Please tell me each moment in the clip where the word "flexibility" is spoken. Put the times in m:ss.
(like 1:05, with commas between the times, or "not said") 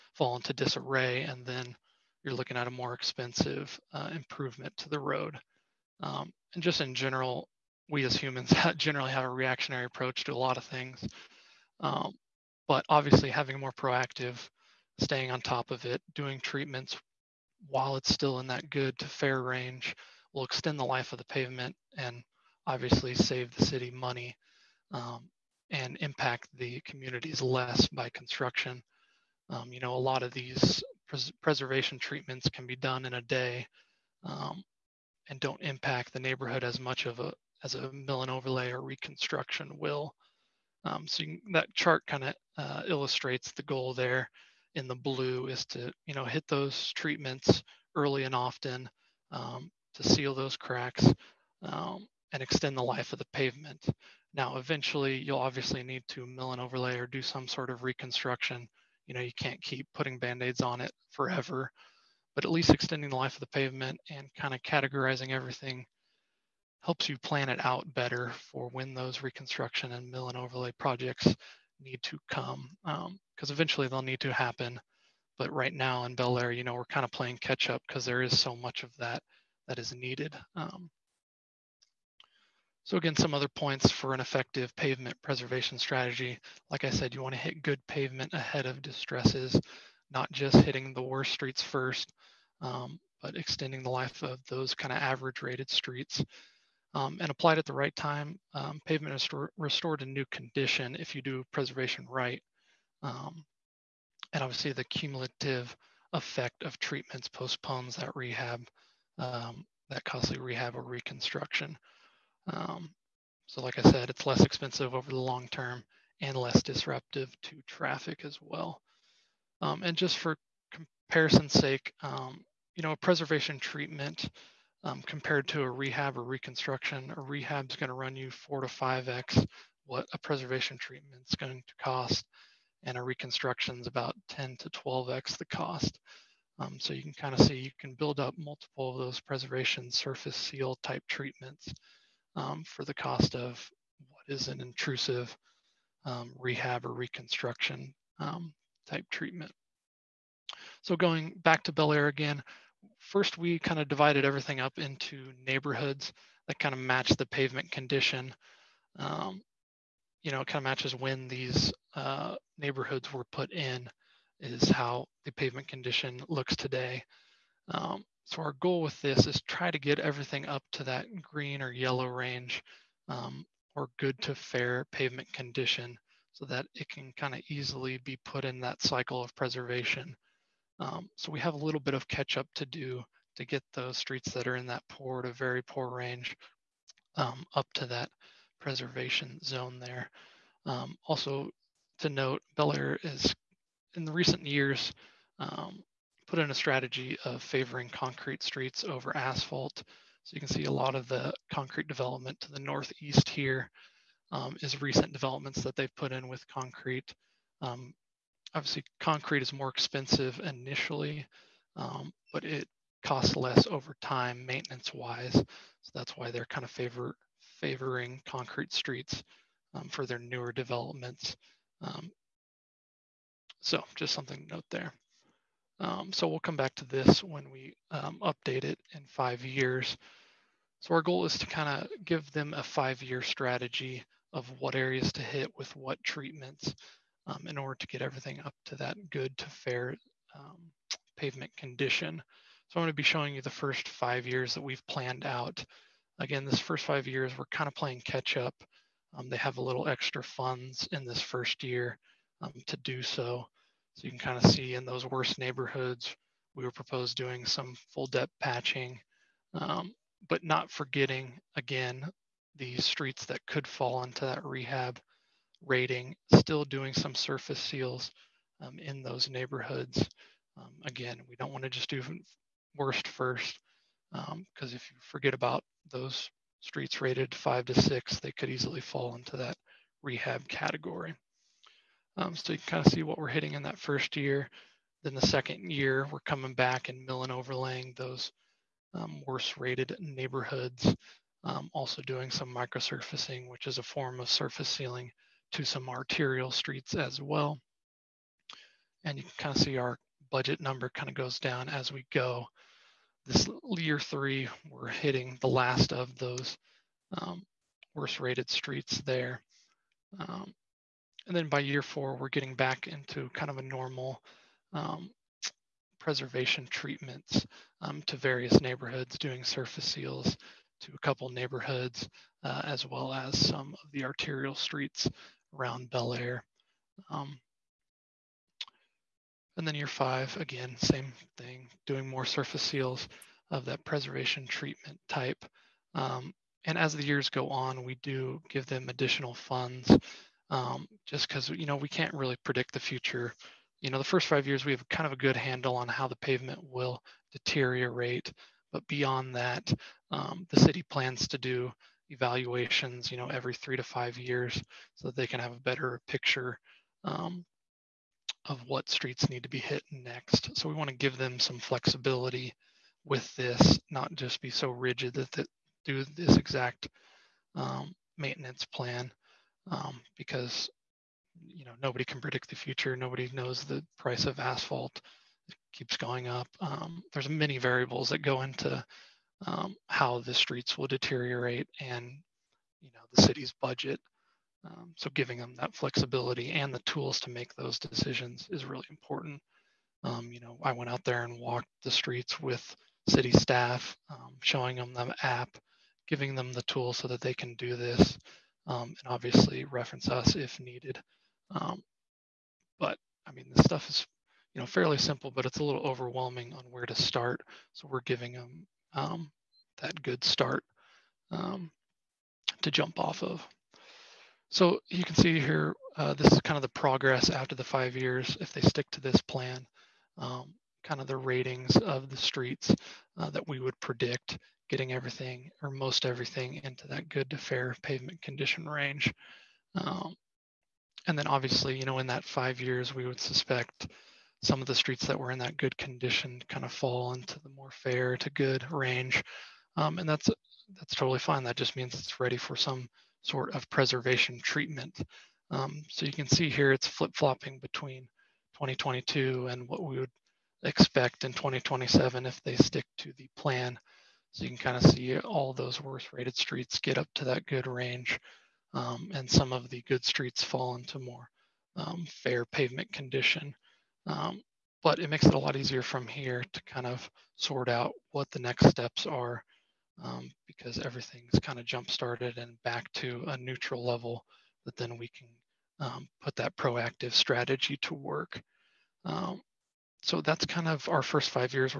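6:01, 6:25.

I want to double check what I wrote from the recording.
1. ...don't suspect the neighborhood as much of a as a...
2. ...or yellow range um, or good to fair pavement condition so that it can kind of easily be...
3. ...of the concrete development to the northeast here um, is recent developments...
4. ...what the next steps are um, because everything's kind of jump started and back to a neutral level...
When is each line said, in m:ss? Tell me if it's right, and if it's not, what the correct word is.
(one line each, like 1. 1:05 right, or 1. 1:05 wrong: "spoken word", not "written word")
1. 0:35 wrong: "impact", not "suspect"
2. 2:51 right
3. 3:20 right
4. 7:48 right.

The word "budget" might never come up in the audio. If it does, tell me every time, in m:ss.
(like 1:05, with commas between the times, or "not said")
5:00, 6:23.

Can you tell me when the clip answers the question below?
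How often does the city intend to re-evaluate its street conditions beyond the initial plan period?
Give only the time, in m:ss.
5:53.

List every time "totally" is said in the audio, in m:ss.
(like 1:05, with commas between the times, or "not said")
7:20.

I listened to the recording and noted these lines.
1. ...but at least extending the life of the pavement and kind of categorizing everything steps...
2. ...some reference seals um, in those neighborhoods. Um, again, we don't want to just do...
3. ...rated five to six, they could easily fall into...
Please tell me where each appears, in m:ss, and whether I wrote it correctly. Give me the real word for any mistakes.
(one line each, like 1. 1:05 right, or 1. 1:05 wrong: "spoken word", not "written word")
1. 1:02 wrong: "helps", not "steps"
2. 4:26 wrong: "surface", not "reference"
3. 4:37 right.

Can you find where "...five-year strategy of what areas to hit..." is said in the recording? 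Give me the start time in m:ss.
3:52.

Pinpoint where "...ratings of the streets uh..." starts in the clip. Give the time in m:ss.
7:01.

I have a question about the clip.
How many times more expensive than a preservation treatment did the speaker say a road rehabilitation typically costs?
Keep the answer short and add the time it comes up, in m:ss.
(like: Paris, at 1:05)
4 to 5 times, at 2:08.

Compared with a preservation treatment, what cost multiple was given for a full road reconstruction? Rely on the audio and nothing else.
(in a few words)
10 to 12 times.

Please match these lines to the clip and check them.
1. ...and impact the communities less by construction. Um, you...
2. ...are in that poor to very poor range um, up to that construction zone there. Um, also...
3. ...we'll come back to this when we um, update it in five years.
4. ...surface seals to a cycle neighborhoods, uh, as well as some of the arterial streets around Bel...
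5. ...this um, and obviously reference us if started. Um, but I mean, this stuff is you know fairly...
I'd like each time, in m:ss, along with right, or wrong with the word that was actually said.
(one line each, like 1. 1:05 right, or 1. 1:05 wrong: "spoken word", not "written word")
1. 0:25 right
2. 3:04 wrong: "preservation", not "construction"
3. 3:46 right
4. 5:19 wrong: "couple", not "cycle"
5. 6:37 wrong: "needed", not "started".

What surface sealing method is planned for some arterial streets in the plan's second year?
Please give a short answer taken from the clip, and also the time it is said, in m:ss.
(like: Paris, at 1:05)
Microsurfacing, at 4:52.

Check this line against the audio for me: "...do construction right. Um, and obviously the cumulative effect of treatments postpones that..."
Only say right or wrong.
wrong.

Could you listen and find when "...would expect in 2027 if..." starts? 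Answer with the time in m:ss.
7:29.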